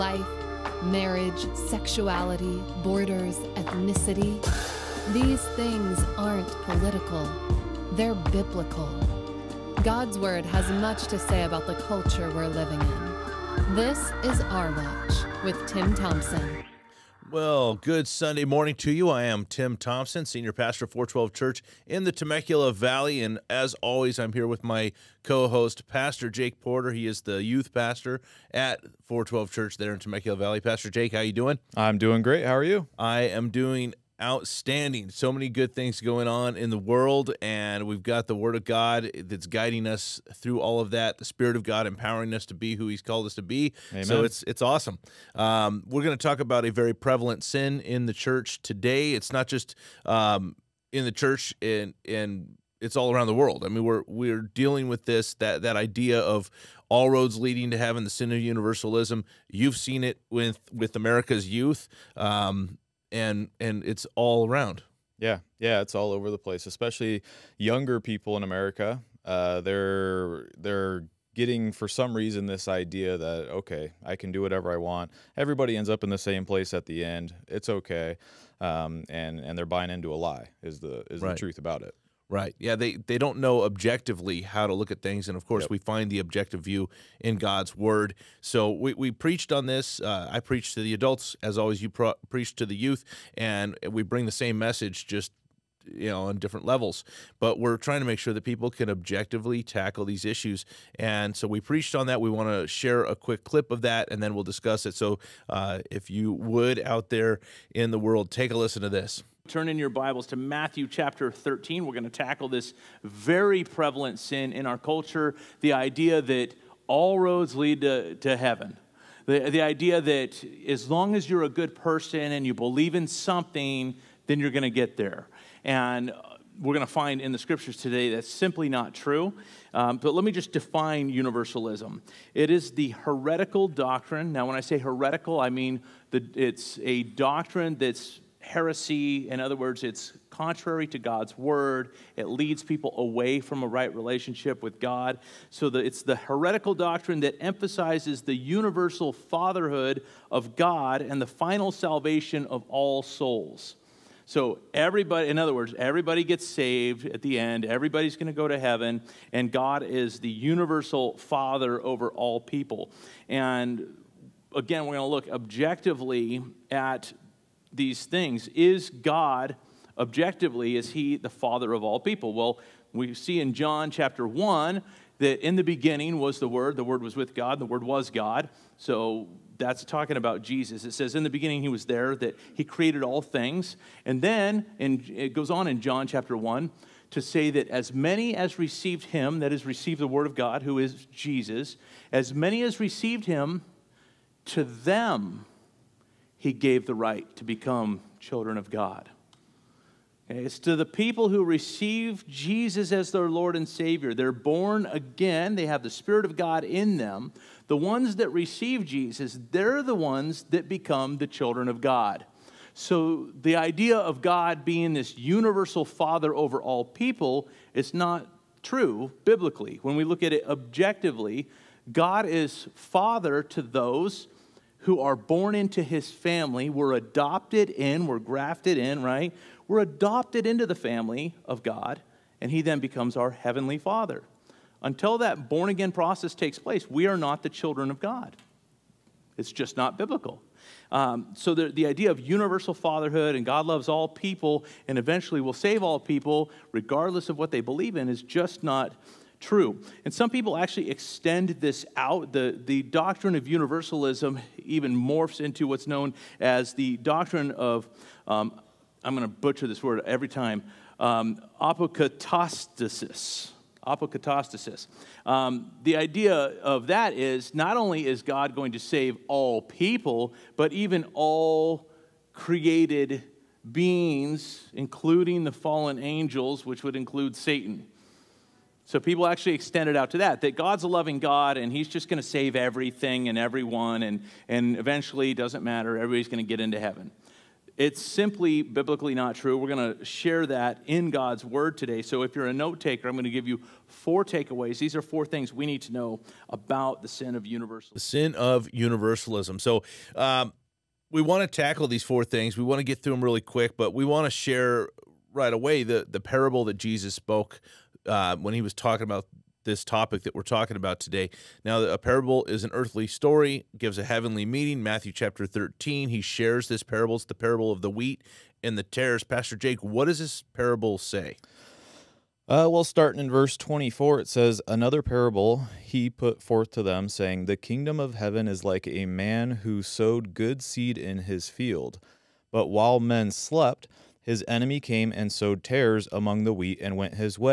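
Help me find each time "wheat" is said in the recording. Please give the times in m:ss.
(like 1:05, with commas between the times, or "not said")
5:17, 5:36.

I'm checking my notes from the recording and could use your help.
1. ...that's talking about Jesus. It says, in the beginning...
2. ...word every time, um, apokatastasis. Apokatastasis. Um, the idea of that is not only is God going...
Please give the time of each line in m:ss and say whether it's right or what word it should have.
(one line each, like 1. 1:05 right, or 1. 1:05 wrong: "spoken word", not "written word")
1. 2:59 right
2. 4:19 right.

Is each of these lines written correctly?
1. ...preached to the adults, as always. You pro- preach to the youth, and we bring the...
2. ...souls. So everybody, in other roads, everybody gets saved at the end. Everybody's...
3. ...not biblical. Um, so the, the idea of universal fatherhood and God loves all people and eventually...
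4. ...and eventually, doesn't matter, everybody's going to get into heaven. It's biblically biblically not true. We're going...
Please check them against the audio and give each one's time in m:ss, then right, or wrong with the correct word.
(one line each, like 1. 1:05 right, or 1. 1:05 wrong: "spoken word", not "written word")
1. 1:30 right
2. 2:33 wrong: "words", not "roads"
3. 3:59 right
4. 4:44 wrong: "simply", not "biblically".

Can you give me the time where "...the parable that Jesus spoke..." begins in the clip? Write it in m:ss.
5:06.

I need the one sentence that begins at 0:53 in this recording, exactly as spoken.
I mean, we're we're dealing with this that that idea of all roads leading to heaven, the sin of universalism.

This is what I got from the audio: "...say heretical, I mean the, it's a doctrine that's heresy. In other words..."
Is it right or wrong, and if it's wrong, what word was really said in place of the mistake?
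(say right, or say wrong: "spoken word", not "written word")
right.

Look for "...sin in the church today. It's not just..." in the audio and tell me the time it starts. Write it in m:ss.
0:47.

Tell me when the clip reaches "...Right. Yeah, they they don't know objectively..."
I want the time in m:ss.
1:22.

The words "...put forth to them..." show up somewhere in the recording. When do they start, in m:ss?
5:26.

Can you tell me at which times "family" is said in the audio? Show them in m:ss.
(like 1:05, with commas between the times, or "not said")
3:46, 3:50.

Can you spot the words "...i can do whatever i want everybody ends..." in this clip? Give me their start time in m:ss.
1:14.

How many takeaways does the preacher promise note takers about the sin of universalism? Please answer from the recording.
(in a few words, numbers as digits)
4.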